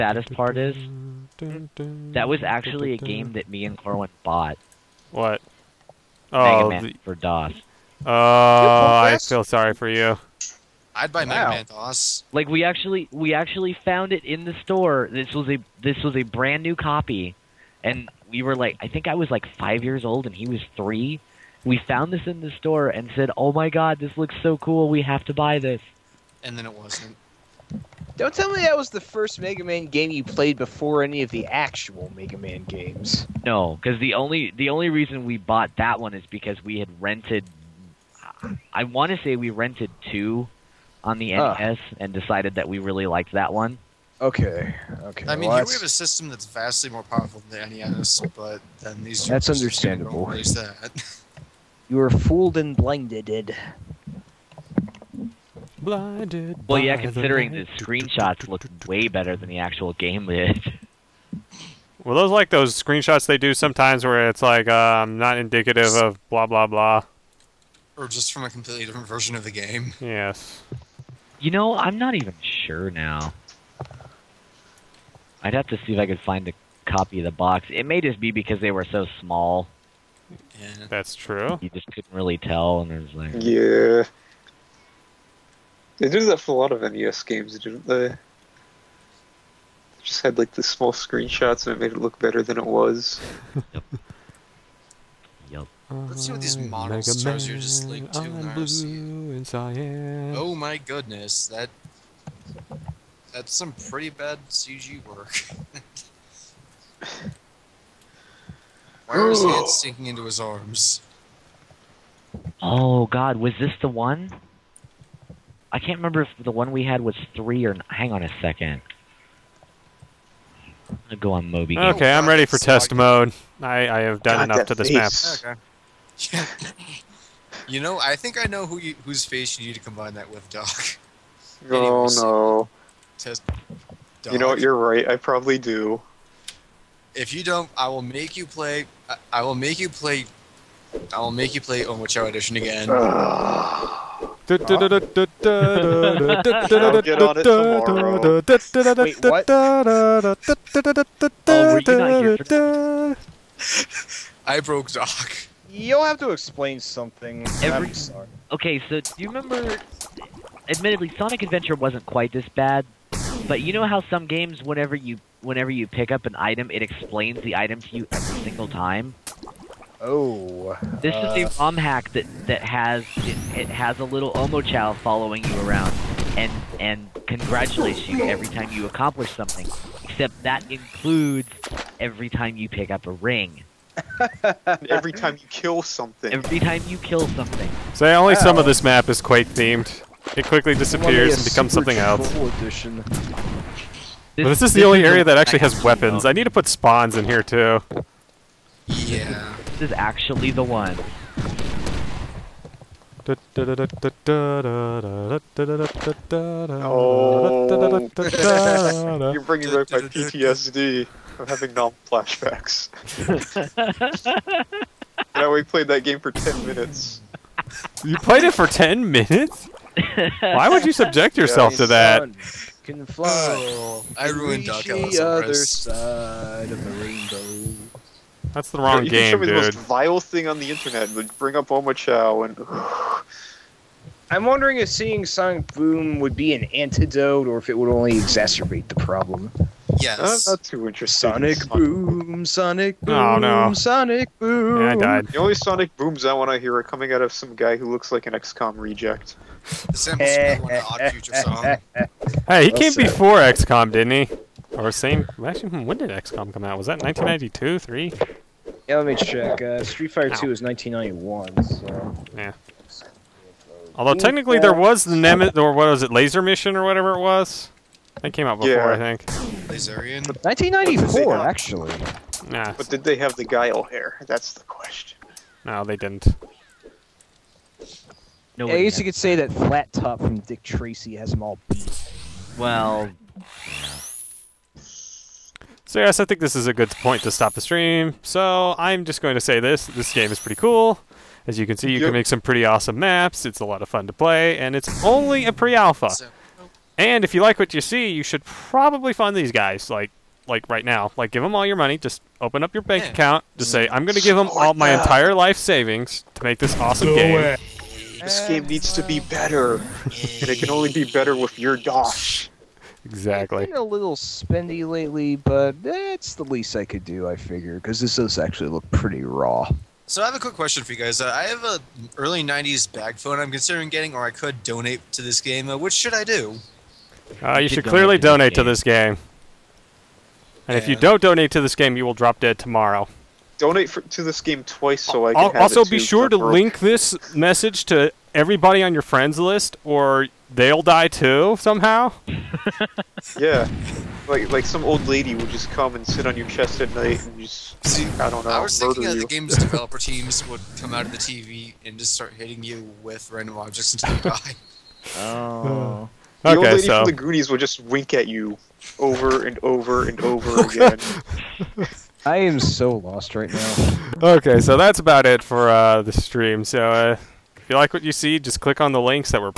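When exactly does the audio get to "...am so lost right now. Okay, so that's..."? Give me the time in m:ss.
6:02.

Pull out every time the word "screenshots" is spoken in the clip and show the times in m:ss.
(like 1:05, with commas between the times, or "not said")
0:57, 1:02, 1:30.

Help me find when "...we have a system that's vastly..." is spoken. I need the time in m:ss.
0:45.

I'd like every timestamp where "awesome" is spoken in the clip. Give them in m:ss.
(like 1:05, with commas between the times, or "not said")
4:52, 5:06.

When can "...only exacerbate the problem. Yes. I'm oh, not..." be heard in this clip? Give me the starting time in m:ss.
3:57.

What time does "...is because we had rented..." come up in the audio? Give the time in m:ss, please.
0:36.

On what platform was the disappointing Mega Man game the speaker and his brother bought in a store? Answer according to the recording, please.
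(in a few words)
DOS.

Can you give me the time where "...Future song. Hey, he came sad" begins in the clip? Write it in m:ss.
4:11.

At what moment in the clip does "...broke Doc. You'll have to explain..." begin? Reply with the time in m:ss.
2:34.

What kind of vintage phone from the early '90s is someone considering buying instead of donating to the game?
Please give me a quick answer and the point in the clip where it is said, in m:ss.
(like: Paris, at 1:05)
bag phone, at 5:22.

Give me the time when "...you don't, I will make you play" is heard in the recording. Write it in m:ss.
2:17.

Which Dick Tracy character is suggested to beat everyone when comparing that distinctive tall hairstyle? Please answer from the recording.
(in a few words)
Flat Top.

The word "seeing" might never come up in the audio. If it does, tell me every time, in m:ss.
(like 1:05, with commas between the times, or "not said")
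3:54.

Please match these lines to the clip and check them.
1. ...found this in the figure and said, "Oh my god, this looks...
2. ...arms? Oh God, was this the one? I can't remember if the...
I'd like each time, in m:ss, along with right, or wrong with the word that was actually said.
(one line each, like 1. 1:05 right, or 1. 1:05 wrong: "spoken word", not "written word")
1. 0:21 wrong: "store", not "figure"
2. 1:50 right.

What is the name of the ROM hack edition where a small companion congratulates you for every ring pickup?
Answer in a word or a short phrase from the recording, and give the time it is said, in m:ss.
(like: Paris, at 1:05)
Omochao Edition, at 2:21.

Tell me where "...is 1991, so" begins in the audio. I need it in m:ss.
4:20.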